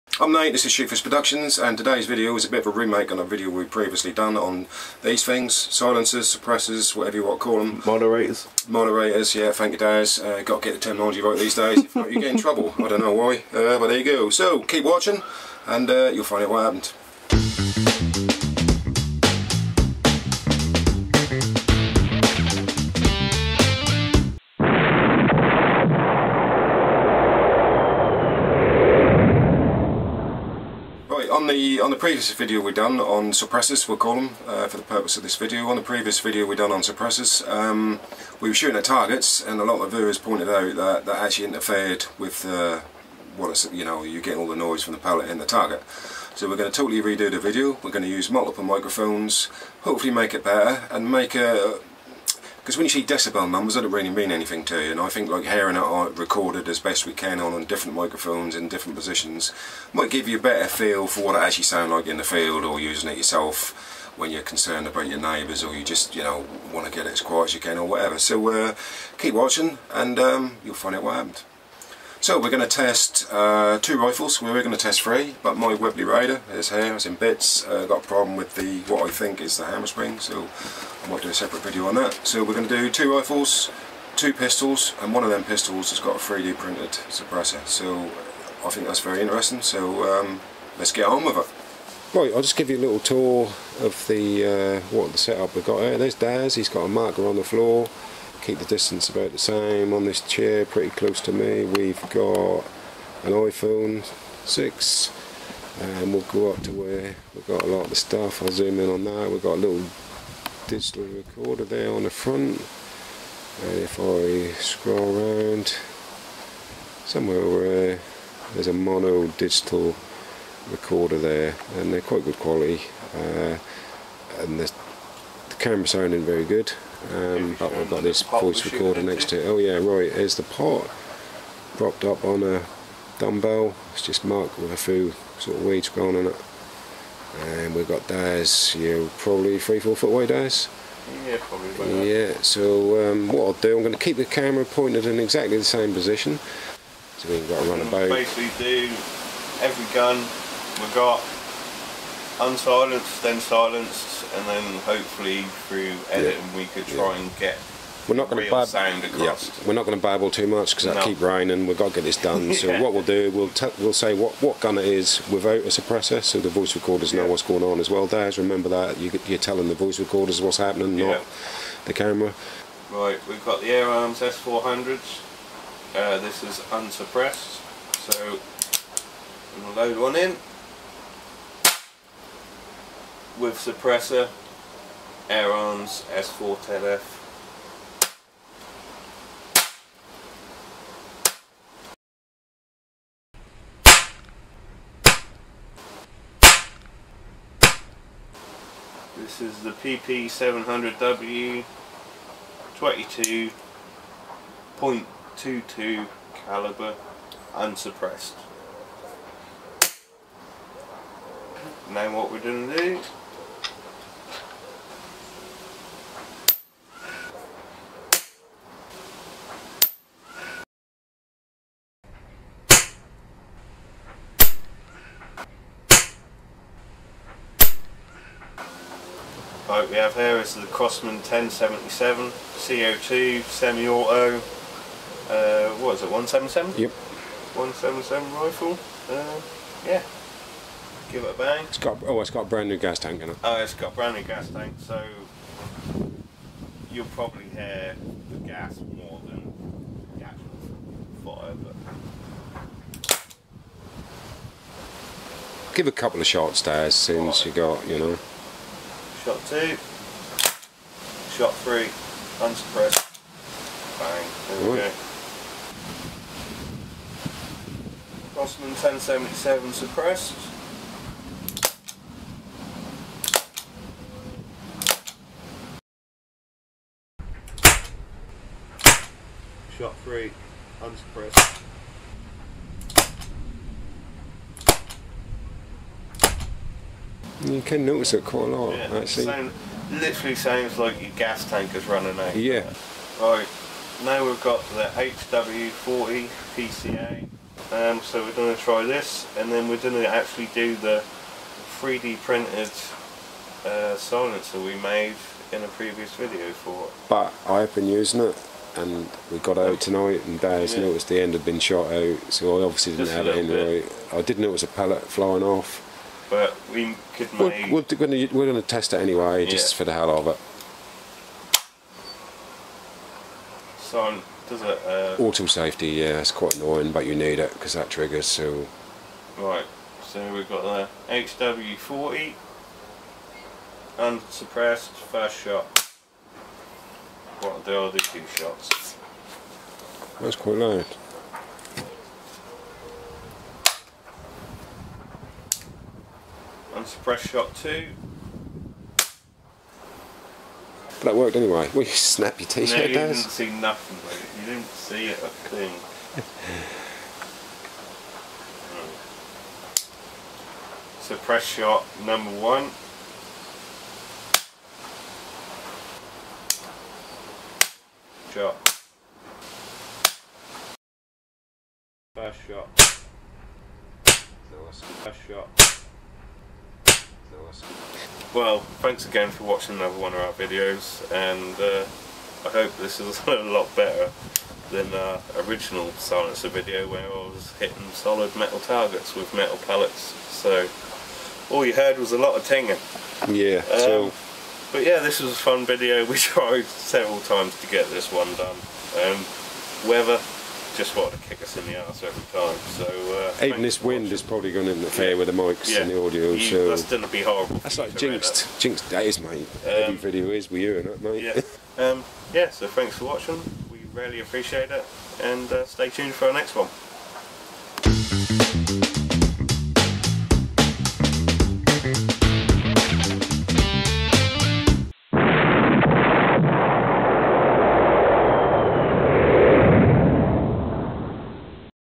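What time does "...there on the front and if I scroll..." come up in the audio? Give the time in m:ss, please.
1:51.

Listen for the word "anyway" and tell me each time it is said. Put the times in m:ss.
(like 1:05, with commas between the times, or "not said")
5:19, 5:51.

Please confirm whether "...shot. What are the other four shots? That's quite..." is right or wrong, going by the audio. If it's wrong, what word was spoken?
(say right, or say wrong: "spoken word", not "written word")
wrong: "two", not "four".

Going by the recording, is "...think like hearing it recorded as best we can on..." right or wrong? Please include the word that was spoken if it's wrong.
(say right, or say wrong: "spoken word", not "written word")
right.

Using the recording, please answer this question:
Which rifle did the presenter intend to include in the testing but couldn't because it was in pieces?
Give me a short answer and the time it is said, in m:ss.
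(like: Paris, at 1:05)
Webley Raider, at 1:15.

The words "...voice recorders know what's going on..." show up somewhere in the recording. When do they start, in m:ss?
2:46.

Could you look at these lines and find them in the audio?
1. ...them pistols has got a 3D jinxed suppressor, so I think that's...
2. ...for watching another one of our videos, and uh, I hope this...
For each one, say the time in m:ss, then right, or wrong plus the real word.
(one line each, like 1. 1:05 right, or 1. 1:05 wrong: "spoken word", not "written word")
1. 1:25 wrong: "printed", not "jinxed"
2. 6:19 right.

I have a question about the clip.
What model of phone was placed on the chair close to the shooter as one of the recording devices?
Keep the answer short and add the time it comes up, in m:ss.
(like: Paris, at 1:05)
iPhone 6, at 1:43.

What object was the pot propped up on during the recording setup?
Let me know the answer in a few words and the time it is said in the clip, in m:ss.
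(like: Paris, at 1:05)
A dumbbell, at 2:13.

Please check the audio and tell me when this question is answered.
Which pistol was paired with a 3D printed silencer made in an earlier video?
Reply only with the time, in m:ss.
4:54.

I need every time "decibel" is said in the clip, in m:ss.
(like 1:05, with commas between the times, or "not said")
0:53.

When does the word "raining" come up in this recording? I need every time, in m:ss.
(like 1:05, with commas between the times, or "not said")
2:41.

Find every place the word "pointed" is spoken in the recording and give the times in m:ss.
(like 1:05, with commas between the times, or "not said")
0:40, 2:24.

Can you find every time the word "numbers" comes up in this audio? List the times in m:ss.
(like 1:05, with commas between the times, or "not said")
0:53, 6:02.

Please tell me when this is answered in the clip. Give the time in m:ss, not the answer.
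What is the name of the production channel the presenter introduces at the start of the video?
0:00.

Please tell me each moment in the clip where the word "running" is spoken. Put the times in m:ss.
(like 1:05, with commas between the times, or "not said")
4:51.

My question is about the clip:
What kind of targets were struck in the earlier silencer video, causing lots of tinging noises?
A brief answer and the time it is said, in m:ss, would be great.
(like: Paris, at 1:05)
Solid metal targets, at 6:27.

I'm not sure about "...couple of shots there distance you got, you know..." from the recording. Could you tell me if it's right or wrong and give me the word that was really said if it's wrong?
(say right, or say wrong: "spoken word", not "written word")
wrong: "since", not "distance".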